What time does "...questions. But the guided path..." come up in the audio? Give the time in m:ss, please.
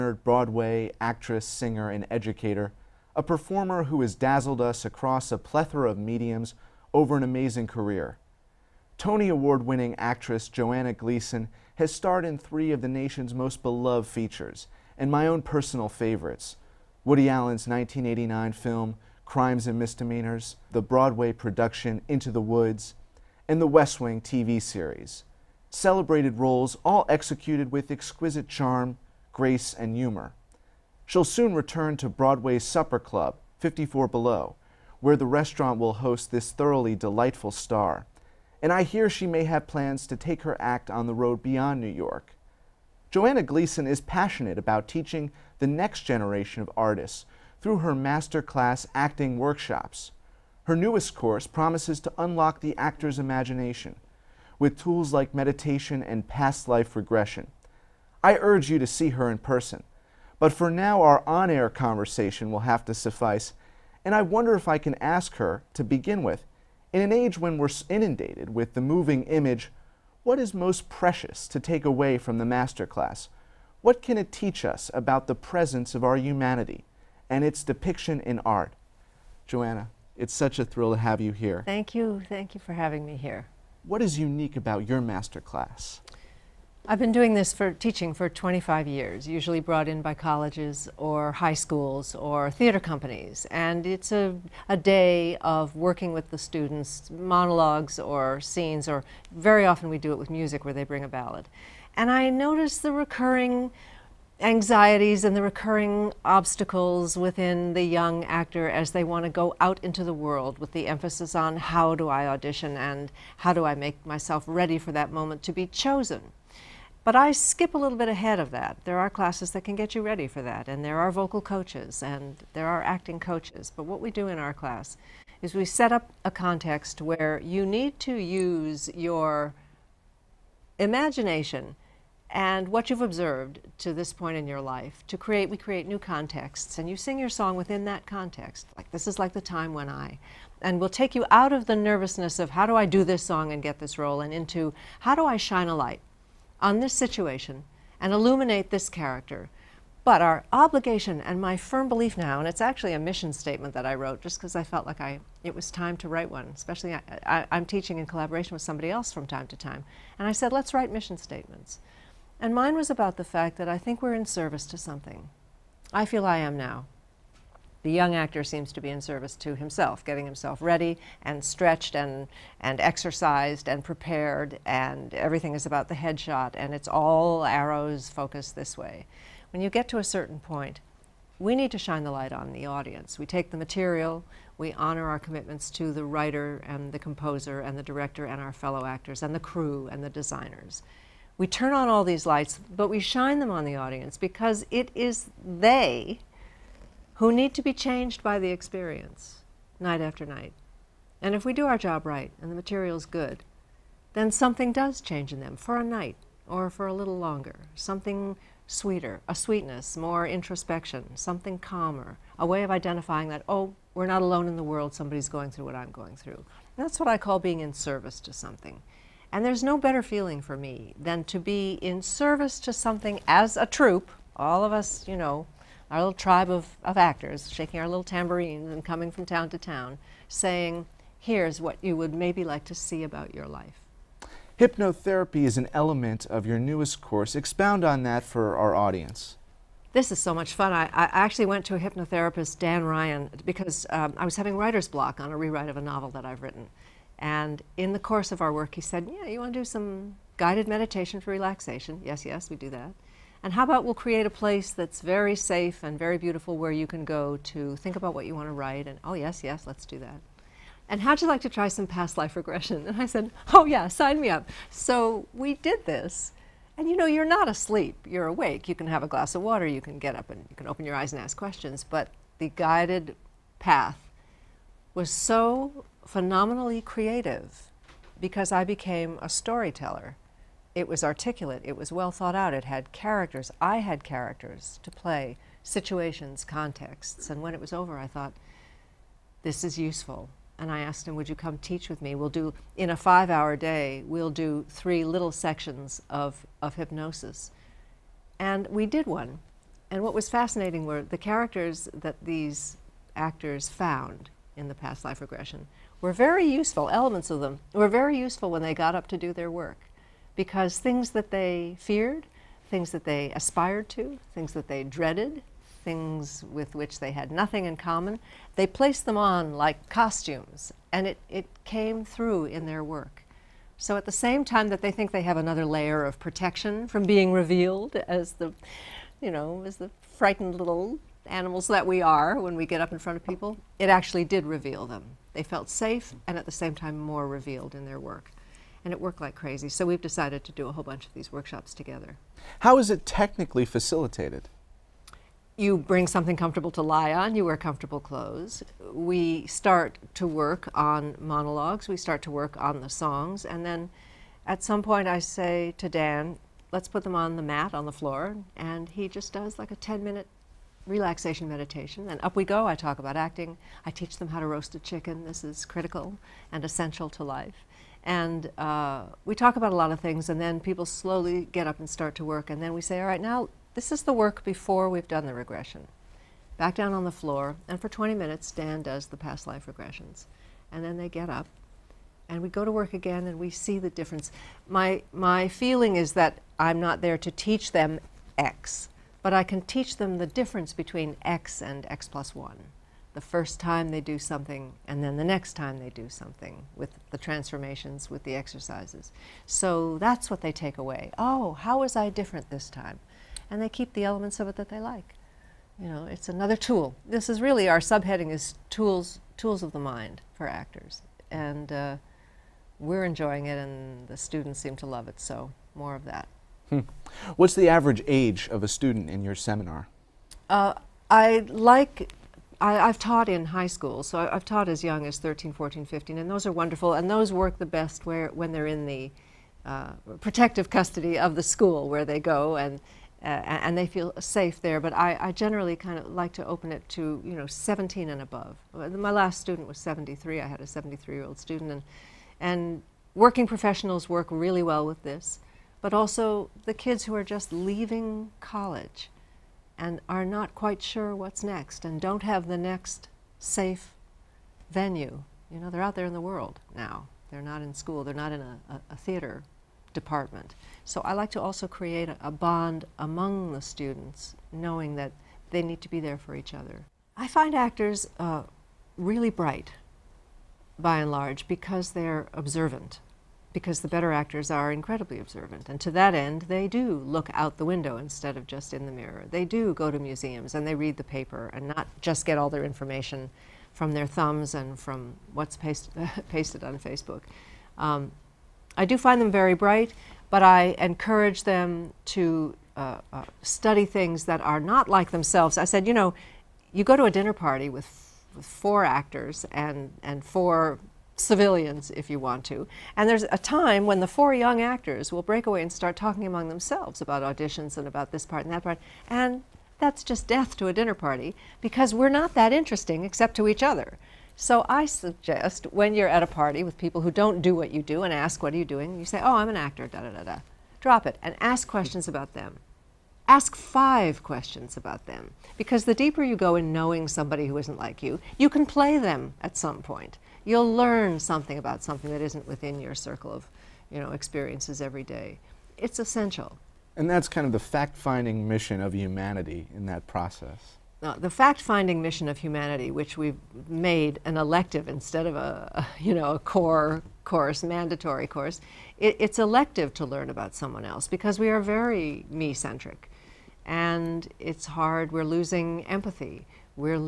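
4:31.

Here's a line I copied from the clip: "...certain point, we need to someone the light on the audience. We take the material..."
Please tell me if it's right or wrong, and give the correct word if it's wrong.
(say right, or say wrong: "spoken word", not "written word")
wrong: "shine", not "someone".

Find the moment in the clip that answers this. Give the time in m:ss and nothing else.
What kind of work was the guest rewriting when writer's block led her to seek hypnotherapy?
4:05.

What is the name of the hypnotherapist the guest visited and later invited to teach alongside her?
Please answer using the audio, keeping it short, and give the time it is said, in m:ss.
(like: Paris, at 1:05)
Dan Ryan, at 4:02.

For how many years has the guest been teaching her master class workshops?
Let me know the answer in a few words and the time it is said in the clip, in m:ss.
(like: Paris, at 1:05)
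25, at 1:28.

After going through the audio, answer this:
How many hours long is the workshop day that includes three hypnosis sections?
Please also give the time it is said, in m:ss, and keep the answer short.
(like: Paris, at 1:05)
5, at 4:52.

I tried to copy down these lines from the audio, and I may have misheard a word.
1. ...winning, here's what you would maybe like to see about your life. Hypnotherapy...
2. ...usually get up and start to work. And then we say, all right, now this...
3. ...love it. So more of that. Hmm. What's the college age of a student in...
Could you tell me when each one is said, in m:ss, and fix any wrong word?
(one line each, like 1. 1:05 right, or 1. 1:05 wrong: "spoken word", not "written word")
1. 3:50 wrong: "saying", not "winning"
2. 6:10 wrong: "slowly", not "usually"
3. 6:54 wrong: "average", not "college".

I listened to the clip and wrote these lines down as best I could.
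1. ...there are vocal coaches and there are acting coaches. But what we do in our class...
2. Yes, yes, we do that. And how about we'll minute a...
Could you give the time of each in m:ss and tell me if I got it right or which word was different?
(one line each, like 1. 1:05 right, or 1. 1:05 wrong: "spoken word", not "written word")
1. 2:00 right
2. 4:12 wrong: "create", not "minute".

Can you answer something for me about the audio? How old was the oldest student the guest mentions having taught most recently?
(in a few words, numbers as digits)
73.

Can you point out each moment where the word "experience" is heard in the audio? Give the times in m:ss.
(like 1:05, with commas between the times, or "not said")
3:18, 8:54.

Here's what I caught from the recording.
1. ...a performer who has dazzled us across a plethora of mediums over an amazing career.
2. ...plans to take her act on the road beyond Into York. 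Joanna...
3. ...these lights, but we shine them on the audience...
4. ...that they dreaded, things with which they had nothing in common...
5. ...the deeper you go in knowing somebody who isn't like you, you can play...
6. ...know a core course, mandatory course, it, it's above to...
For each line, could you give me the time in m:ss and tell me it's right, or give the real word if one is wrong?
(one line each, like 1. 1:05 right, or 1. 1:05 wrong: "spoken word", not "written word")
1. 0:03 right
2. 0:39 wrong: "New", not "Into"
3. 3:12 right
4. 5:14 right
5. 8:45 right
6. 9:06 wrong: "elective", not "above".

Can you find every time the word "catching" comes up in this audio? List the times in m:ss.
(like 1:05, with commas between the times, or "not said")
not said.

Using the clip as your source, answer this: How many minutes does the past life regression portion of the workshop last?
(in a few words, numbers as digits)
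20.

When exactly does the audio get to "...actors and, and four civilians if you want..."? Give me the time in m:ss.
8:18.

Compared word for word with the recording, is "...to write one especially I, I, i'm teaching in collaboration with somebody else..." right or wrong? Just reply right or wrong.
right.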